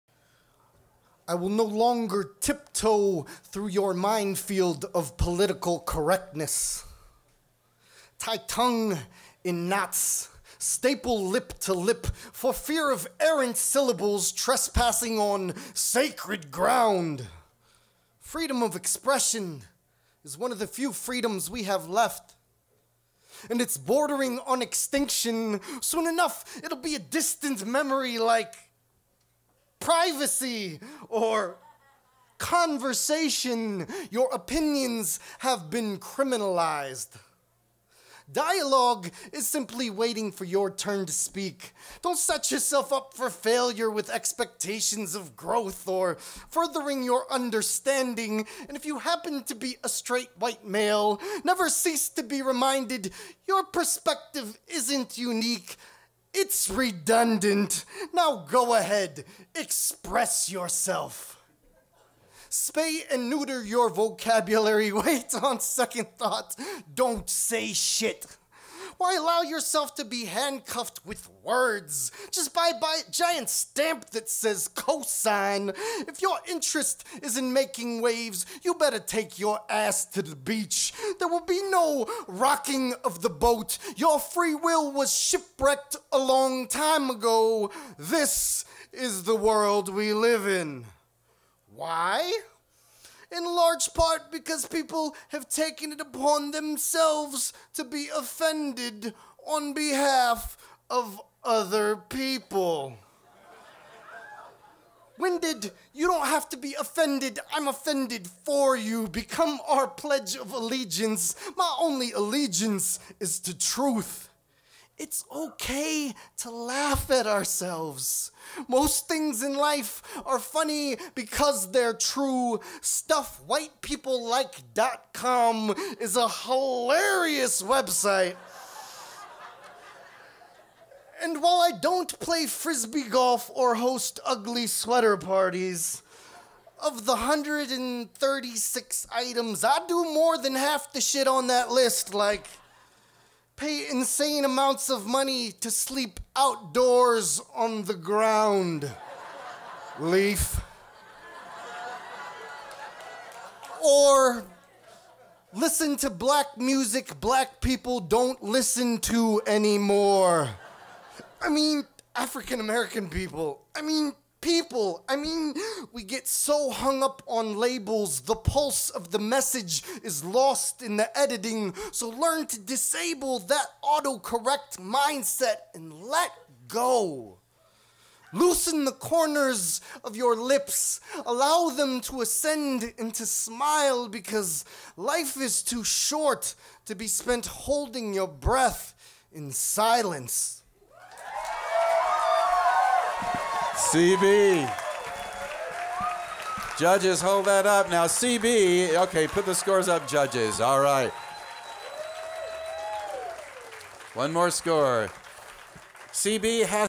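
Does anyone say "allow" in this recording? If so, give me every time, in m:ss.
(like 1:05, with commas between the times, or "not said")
1:09, 3:01.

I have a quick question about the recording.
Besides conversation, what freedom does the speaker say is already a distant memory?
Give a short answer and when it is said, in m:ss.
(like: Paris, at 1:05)
privacy, at 0:29.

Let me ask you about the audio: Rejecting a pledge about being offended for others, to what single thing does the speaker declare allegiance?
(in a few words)
truth.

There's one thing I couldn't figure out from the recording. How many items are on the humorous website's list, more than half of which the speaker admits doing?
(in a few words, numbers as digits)
136.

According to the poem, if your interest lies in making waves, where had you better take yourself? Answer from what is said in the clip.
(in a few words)
the beach.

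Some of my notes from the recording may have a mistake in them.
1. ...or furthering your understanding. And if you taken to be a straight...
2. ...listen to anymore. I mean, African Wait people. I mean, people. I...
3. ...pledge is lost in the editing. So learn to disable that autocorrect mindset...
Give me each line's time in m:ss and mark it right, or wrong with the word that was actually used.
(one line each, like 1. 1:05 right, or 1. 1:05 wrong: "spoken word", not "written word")
1. 0:45 wrong: "happen", not "taken"
2. 2:38 wrong: "American", not "Wait"
3. 2:49 wrong: "message", not "pledge".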